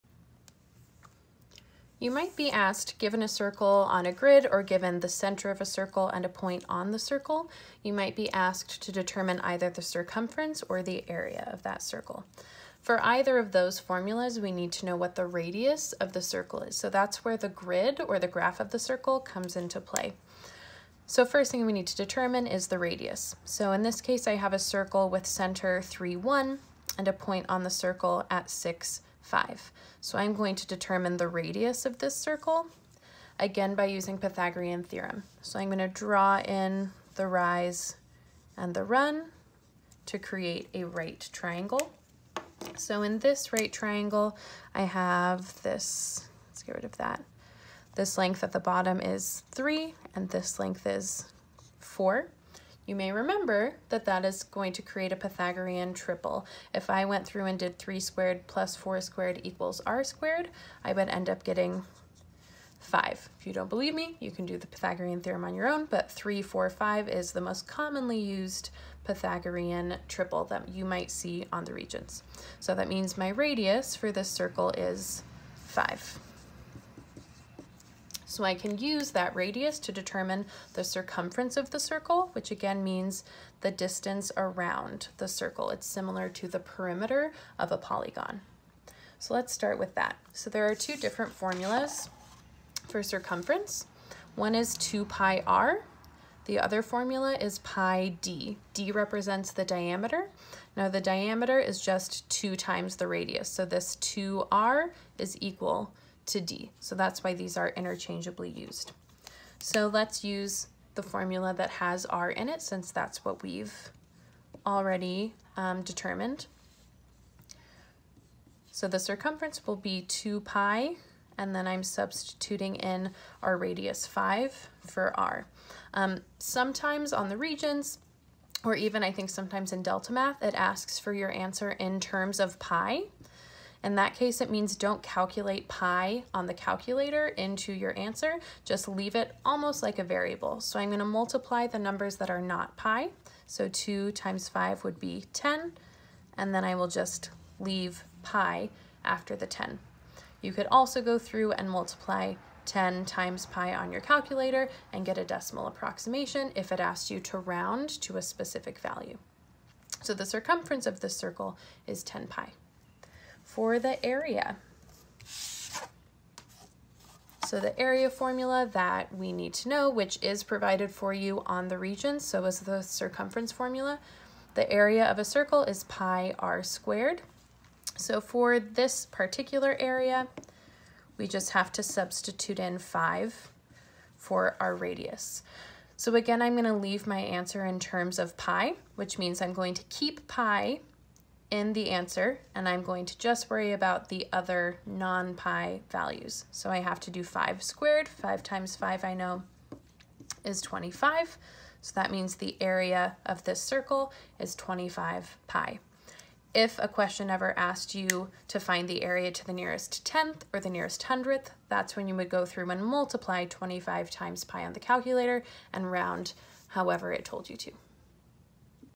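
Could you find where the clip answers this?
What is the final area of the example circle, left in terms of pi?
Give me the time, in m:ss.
3:24.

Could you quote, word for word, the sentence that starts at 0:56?
If I went through and did 3 squared plus 4 squared equals r squared, I would end up getting 5.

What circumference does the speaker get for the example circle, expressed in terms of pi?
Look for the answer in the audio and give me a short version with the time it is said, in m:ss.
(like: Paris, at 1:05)
10 pi, at 2:42.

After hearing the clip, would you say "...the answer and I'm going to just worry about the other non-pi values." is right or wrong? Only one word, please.
right.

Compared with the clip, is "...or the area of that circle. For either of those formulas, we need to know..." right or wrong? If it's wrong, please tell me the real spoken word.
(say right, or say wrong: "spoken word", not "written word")
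right.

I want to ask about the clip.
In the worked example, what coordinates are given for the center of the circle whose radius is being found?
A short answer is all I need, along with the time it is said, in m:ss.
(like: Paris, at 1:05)
3, 1, at 0:25.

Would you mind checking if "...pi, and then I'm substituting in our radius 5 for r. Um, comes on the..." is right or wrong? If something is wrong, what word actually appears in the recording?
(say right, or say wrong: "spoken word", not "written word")
wrong: "sometimes", not "comes".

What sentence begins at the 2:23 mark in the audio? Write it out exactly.
So two times five would be 10, and then I will just leave pi after the 10.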